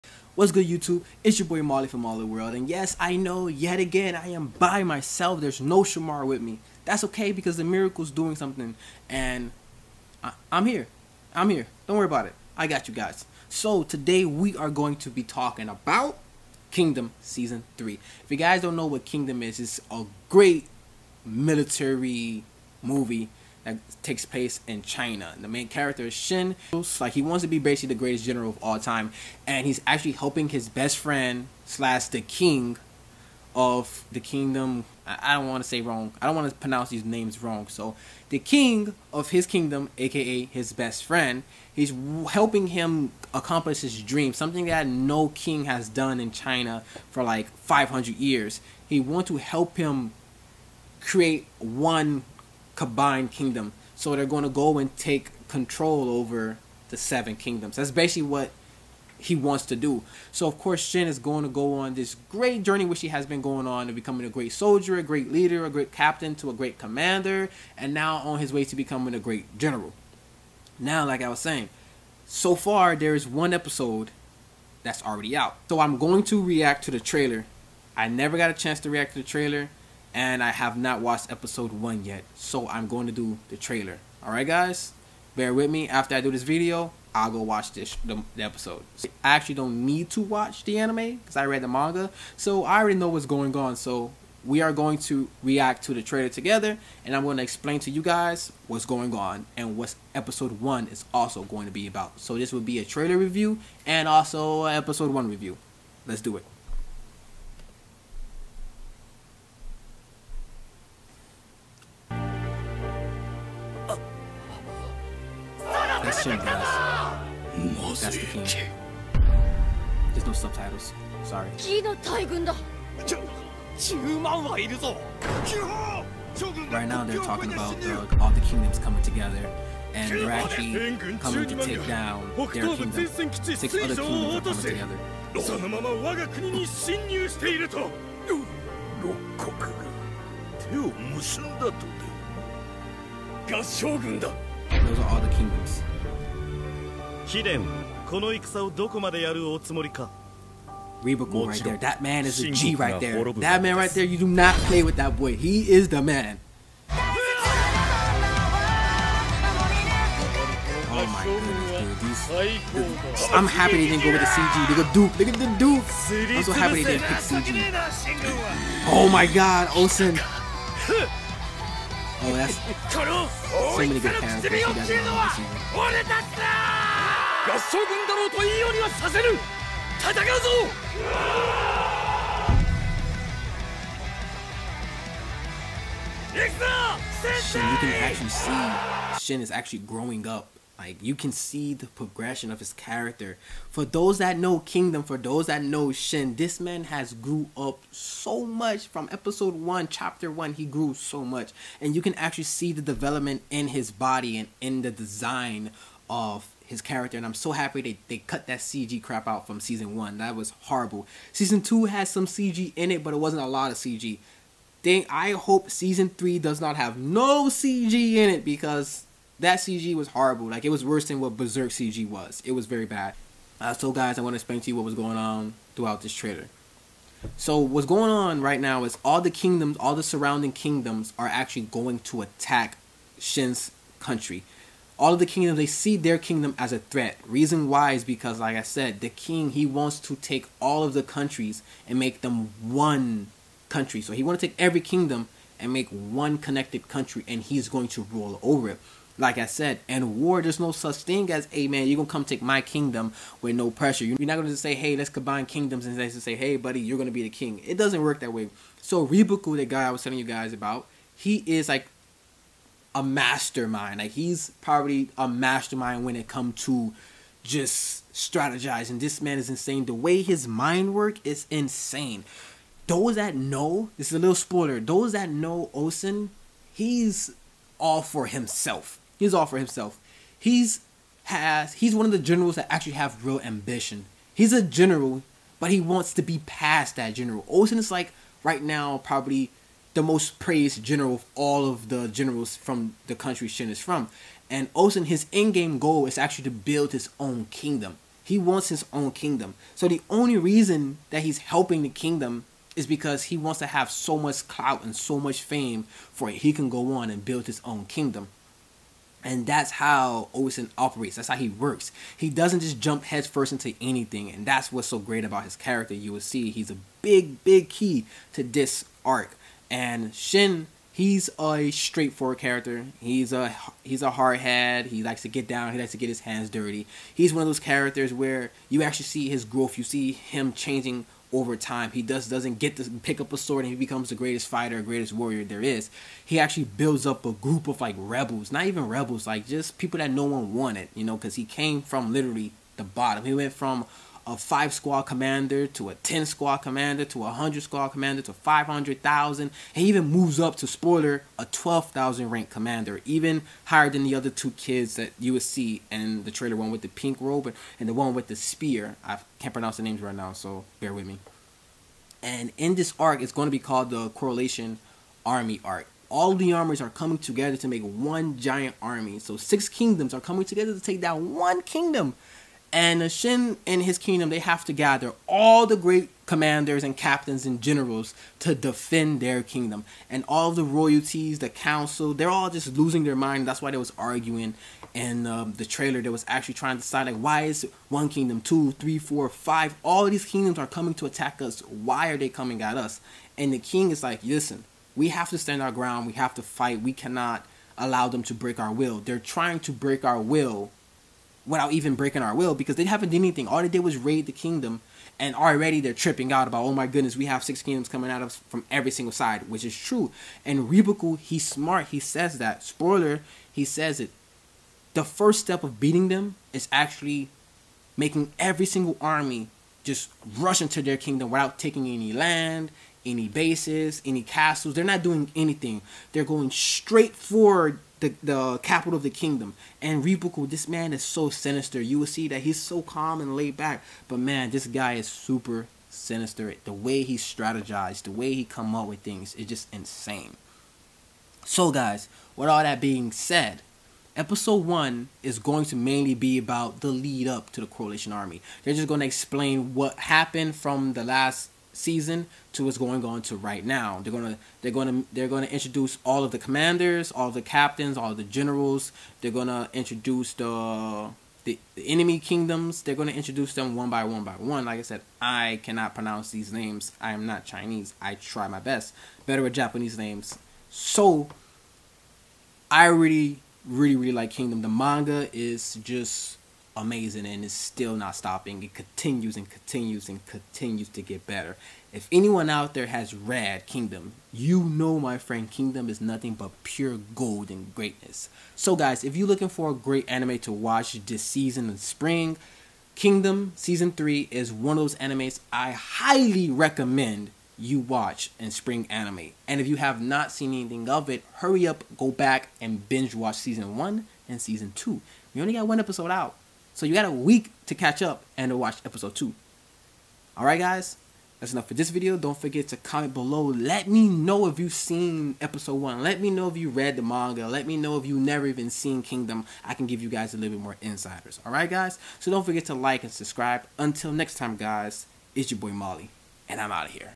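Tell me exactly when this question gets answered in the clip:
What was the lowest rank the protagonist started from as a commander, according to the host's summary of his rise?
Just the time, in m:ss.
5:44.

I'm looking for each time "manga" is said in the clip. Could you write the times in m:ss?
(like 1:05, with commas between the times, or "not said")
1:31, 7:54, 8:37.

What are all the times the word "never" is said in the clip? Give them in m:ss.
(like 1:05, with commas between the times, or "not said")
1:18, 8:38.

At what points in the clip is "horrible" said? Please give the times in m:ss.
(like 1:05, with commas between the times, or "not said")
3:30, 3:40.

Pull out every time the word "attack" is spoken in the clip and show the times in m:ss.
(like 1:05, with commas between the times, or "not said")
3:52, 6:31.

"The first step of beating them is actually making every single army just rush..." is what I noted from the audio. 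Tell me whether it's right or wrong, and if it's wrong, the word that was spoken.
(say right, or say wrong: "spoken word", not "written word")
right.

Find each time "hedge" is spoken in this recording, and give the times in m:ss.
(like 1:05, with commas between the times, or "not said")
not said.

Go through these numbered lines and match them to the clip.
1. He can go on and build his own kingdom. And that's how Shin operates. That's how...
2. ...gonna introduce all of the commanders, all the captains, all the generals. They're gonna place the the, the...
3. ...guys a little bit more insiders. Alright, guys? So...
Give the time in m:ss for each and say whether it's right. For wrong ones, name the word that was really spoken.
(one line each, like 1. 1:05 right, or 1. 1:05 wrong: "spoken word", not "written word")
1. 5:06 wrong: "Osen", not "Shin"
2. 7:35 wrong: "introduce", not "place"
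3. 8:40 right.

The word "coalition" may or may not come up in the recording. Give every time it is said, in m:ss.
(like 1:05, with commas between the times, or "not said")
6:04, 7:27.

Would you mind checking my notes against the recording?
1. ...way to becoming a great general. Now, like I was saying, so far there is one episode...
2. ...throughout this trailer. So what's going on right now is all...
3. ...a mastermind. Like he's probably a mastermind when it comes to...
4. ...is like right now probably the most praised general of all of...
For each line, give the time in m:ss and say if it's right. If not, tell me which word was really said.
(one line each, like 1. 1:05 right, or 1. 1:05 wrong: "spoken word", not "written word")
1. 1:08 right
2. 3:45 right
3. 4:22 right
4. 4:47 right.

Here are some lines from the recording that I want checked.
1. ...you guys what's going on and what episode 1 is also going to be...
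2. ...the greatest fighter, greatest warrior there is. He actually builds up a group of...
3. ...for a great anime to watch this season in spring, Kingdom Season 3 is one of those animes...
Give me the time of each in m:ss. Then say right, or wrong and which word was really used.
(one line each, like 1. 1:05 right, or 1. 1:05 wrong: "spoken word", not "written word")
1. 1:37 right
2. 5:34 right
3. 8:09 right.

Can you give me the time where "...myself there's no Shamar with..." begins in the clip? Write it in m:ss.
0:04.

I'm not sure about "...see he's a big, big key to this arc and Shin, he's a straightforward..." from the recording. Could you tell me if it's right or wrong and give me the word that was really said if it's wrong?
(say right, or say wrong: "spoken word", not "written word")
right.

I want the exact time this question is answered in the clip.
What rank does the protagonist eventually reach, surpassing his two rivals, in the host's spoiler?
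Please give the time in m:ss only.
5:51.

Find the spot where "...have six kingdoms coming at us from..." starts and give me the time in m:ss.
6:47.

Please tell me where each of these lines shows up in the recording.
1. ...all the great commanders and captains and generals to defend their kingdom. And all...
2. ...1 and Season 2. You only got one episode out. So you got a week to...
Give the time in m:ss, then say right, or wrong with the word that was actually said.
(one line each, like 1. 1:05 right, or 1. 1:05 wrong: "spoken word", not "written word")
1. 6:15 right
2. 8:23 right.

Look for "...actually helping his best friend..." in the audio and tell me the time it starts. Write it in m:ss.
0:29.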